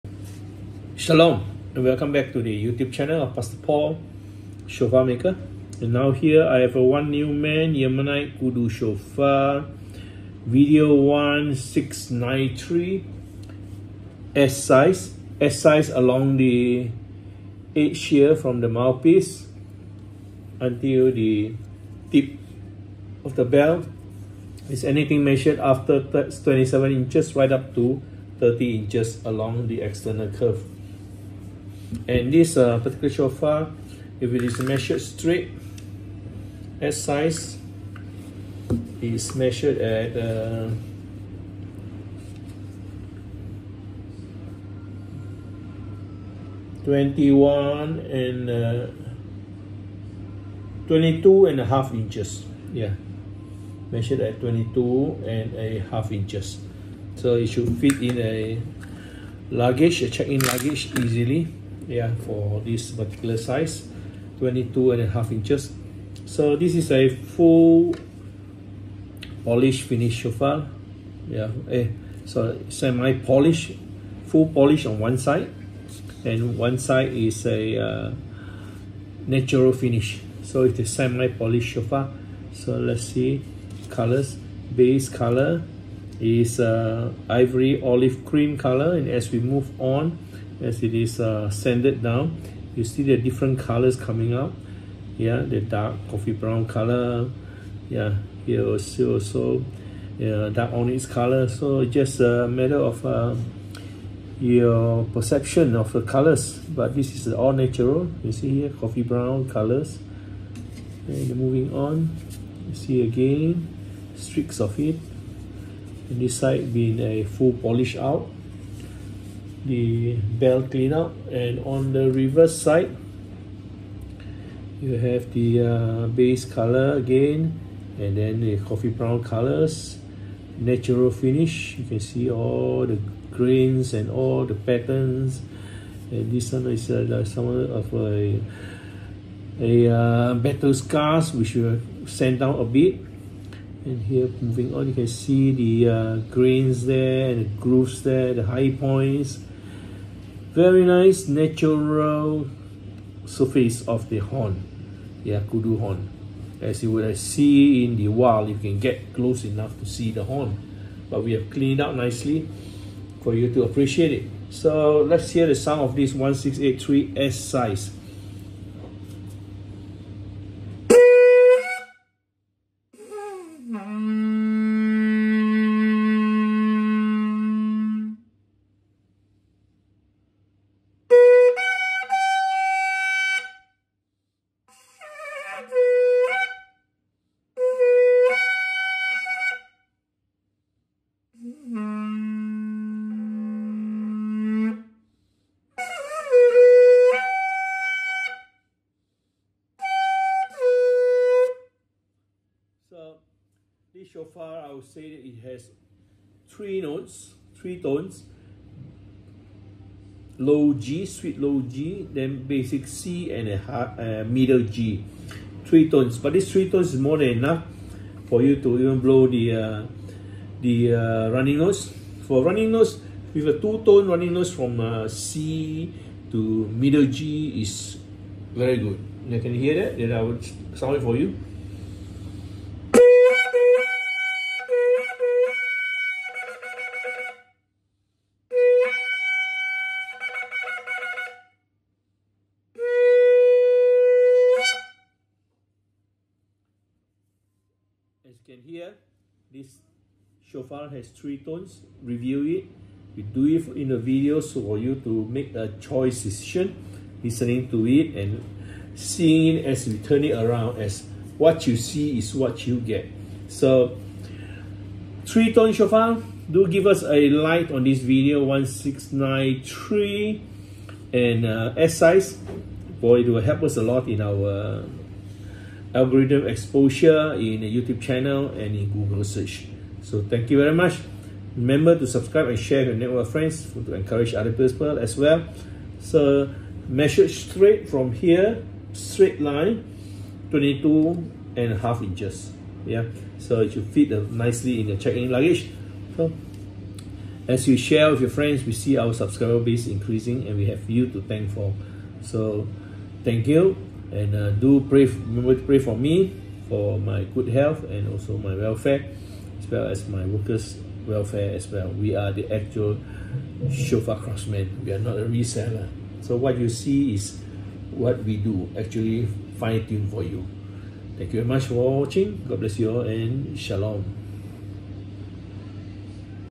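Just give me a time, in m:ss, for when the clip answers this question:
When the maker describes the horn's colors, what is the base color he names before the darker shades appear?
1:27.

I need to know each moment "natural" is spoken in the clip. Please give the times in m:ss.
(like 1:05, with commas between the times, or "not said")
1:19, 1:47, 2:10, 2:31.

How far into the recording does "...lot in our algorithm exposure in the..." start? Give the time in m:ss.
4:33.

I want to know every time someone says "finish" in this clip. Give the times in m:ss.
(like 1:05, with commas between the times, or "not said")
1:09, 1:19, 2:11.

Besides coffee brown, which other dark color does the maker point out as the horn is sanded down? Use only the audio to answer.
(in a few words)
dark onyx.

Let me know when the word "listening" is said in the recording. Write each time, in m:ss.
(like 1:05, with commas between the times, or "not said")
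4:17.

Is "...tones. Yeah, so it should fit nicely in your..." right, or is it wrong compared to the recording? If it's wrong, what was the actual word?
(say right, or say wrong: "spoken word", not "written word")
wrong: "inches", not "tones".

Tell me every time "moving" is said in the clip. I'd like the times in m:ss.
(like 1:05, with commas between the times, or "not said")
1:51, 2:24.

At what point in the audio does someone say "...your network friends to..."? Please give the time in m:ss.
4:42.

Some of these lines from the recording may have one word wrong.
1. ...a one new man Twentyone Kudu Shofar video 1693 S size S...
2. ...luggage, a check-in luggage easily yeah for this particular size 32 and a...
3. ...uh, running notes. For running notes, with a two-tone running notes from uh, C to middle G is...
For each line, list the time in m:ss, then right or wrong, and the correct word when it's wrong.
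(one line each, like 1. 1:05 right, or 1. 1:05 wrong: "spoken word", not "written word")
1. 0:06 wrong: "Yemenite", not "Twentyone"
2. 0:59 wrong: "22", not "32"
3. 3:40 right.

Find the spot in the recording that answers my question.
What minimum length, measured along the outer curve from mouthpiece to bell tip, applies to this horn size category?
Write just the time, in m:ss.
0:26.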